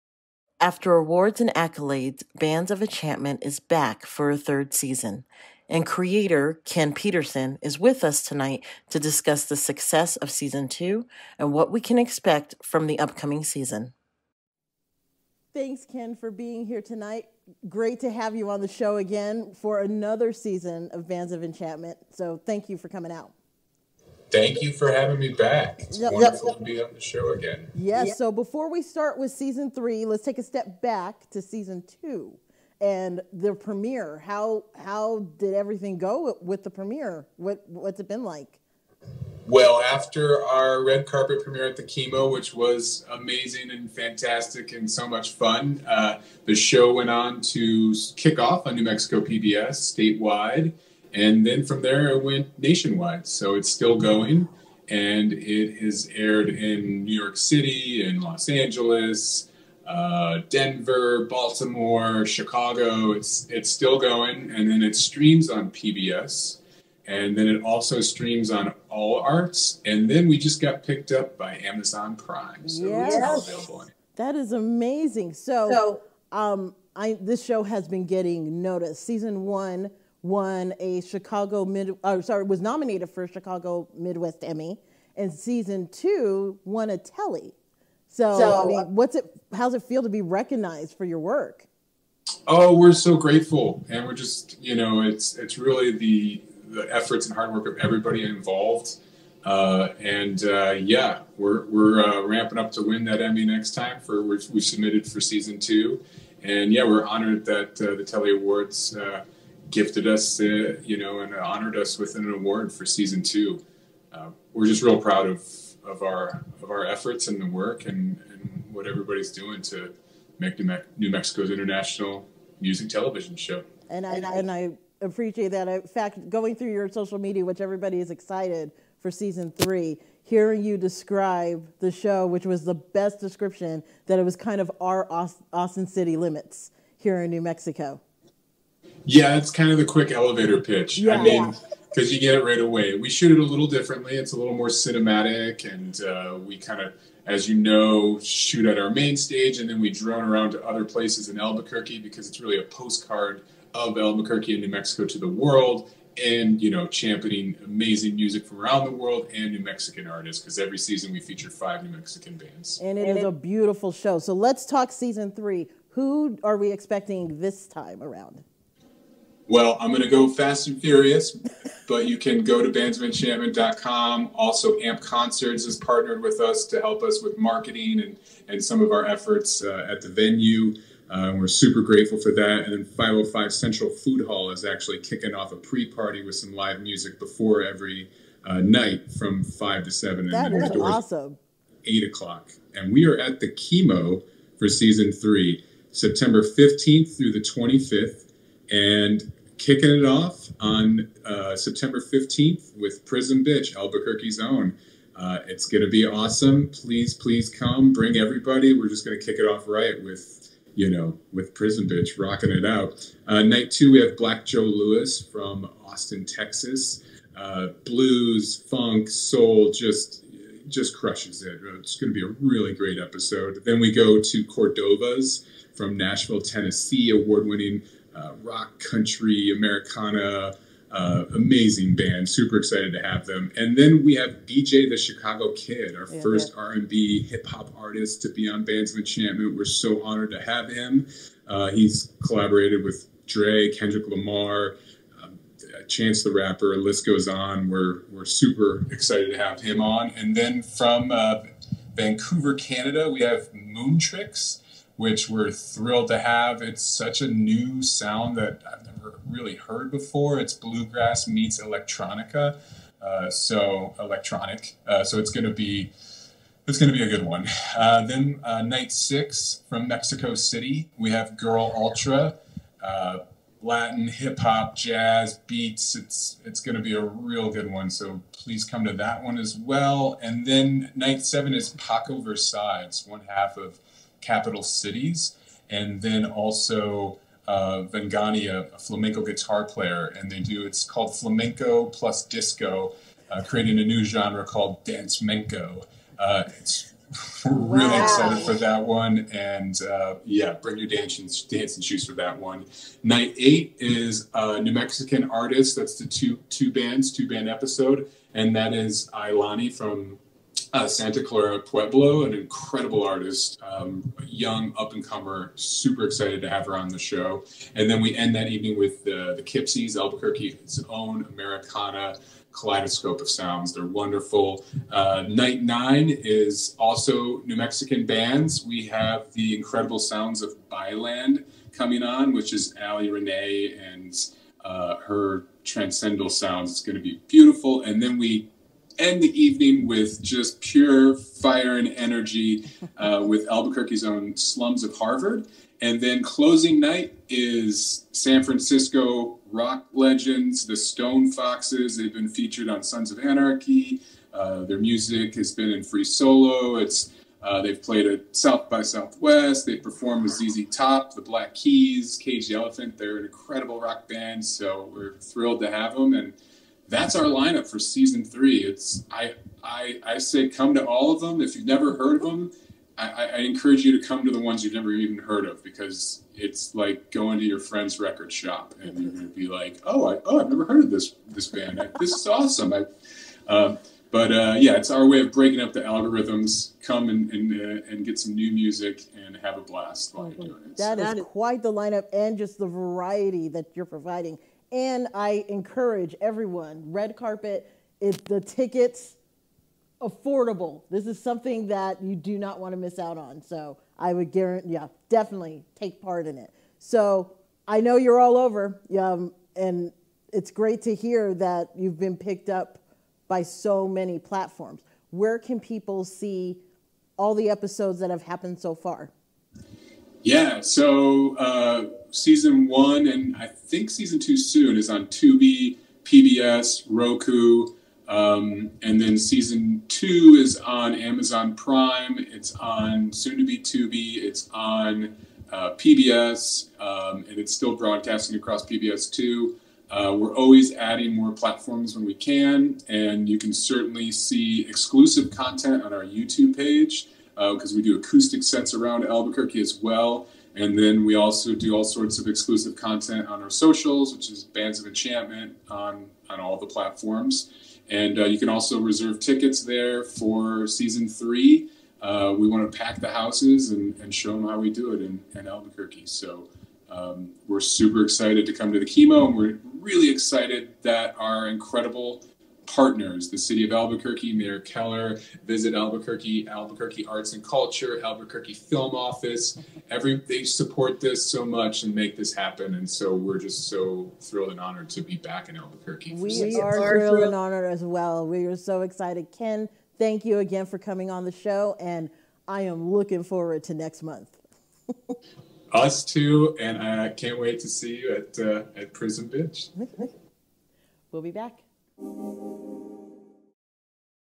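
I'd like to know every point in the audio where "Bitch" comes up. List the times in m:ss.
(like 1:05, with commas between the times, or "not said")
3:23, 3:31, 8:19.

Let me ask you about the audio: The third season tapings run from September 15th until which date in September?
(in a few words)
25th.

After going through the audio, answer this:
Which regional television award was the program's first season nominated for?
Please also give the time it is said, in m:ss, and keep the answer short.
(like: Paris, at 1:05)
Chicago Midwest Emmy, at 1:23.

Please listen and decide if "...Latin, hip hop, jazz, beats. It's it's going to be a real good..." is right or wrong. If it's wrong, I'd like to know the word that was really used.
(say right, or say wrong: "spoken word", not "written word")
right.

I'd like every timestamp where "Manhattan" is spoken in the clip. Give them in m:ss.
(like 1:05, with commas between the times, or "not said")
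not said.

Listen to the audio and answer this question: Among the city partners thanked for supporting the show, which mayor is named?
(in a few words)
Mayor Keller.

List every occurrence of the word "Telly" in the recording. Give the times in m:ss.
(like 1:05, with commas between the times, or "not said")
1:26, 1:48.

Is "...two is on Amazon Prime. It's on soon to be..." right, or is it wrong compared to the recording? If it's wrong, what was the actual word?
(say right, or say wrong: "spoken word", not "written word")
right.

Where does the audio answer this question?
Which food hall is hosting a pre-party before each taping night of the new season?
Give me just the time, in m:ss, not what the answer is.
3:02.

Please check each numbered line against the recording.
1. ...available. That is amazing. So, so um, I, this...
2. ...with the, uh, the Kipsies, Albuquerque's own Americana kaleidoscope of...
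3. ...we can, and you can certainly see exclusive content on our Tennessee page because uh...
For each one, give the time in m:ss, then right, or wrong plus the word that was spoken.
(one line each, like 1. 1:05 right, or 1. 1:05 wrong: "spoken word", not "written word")
1. 1:13 right
2. 5:18 right
3. 7:22 wrong: "YouTube", not "Tennessee".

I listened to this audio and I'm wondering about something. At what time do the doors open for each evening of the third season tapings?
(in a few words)
8 o'clock.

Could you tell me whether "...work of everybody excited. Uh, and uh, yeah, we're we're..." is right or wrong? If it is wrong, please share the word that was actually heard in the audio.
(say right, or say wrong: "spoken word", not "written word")
wrong: "involved", not "excited".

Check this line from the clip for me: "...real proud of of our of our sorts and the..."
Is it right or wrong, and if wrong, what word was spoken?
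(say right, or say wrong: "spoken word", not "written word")
wrong: "efforts", not "sorts".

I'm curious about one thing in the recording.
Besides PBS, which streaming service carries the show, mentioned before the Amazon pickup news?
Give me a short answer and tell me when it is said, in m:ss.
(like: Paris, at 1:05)
All Arts, at 1:08.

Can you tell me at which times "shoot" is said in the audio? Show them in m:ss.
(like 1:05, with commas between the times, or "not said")
2:23, 2:28.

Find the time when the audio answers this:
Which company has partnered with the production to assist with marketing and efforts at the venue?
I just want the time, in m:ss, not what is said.
2:54.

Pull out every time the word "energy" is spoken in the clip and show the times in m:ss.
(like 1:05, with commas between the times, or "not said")
5:41.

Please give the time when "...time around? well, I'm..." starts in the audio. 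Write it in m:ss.
2:47.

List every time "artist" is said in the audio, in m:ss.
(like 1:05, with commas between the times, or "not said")
2:40, 3:57, 5:05, 5:13.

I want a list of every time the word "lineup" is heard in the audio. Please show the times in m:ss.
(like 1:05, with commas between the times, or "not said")
6:07, 6:31.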